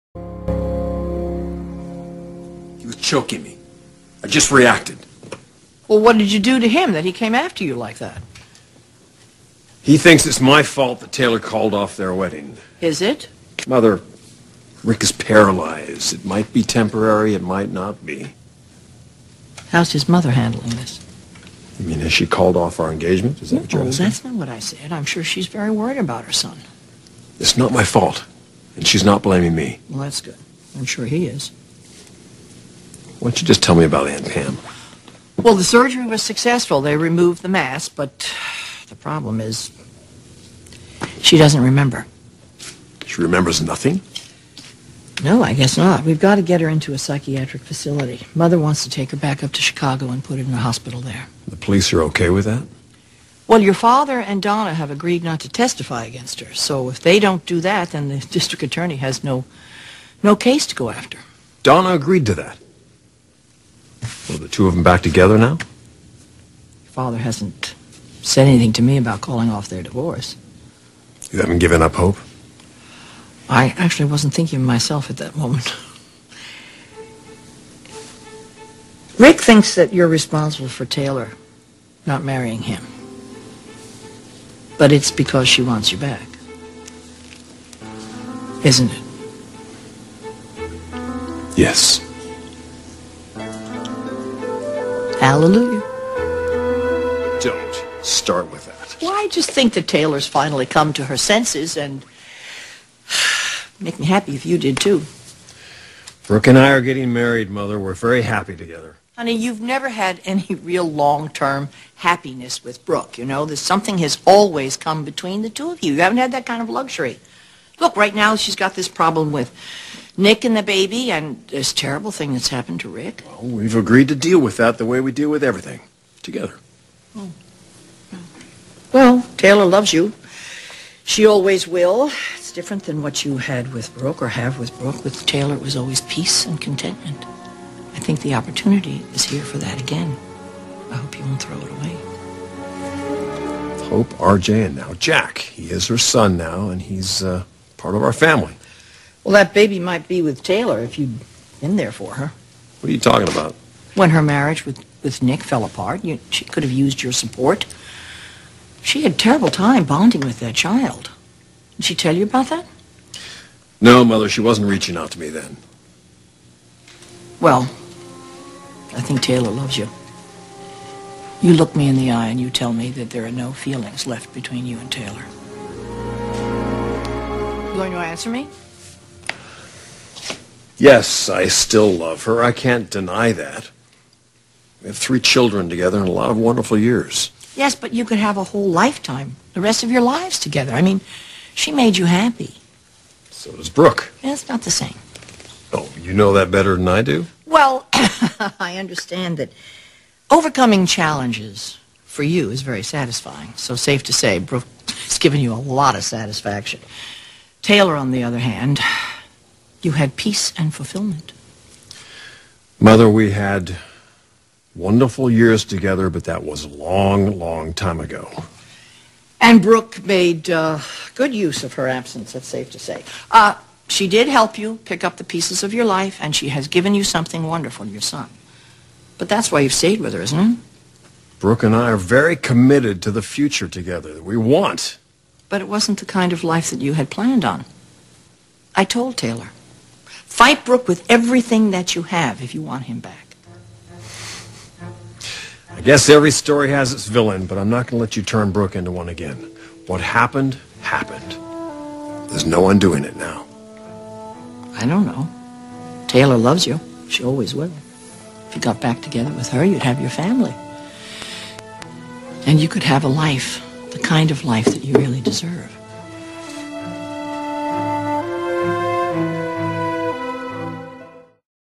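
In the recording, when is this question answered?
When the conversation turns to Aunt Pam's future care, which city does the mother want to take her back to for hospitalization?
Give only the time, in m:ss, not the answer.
0:49.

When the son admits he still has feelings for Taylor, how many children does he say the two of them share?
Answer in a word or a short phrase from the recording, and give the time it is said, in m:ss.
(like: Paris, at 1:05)
3, at 3:04.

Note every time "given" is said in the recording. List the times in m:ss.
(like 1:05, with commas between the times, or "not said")
1:11, 3:25, 3:46.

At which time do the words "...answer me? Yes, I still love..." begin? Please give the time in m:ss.
2:57.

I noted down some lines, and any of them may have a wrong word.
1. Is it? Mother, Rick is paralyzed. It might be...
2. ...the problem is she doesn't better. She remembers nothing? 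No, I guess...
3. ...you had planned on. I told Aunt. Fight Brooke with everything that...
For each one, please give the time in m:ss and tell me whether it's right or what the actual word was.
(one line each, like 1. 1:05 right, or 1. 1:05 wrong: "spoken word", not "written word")
1. 0:12 right
2. 0:38 wrong: "remember", not "better"
3. 3:56 wrong: "Taylor", not "Aunt".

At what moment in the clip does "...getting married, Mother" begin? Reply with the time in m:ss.
1:46.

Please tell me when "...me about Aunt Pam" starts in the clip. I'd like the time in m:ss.
0:33.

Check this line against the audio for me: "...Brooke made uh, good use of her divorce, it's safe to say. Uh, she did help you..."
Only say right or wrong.
wrong.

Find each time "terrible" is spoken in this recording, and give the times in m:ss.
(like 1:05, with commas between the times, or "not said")
2:01, 2:39.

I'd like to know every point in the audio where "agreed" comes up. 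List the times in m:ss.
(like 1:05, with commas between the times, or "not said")
0:54, 1:01, 2:03.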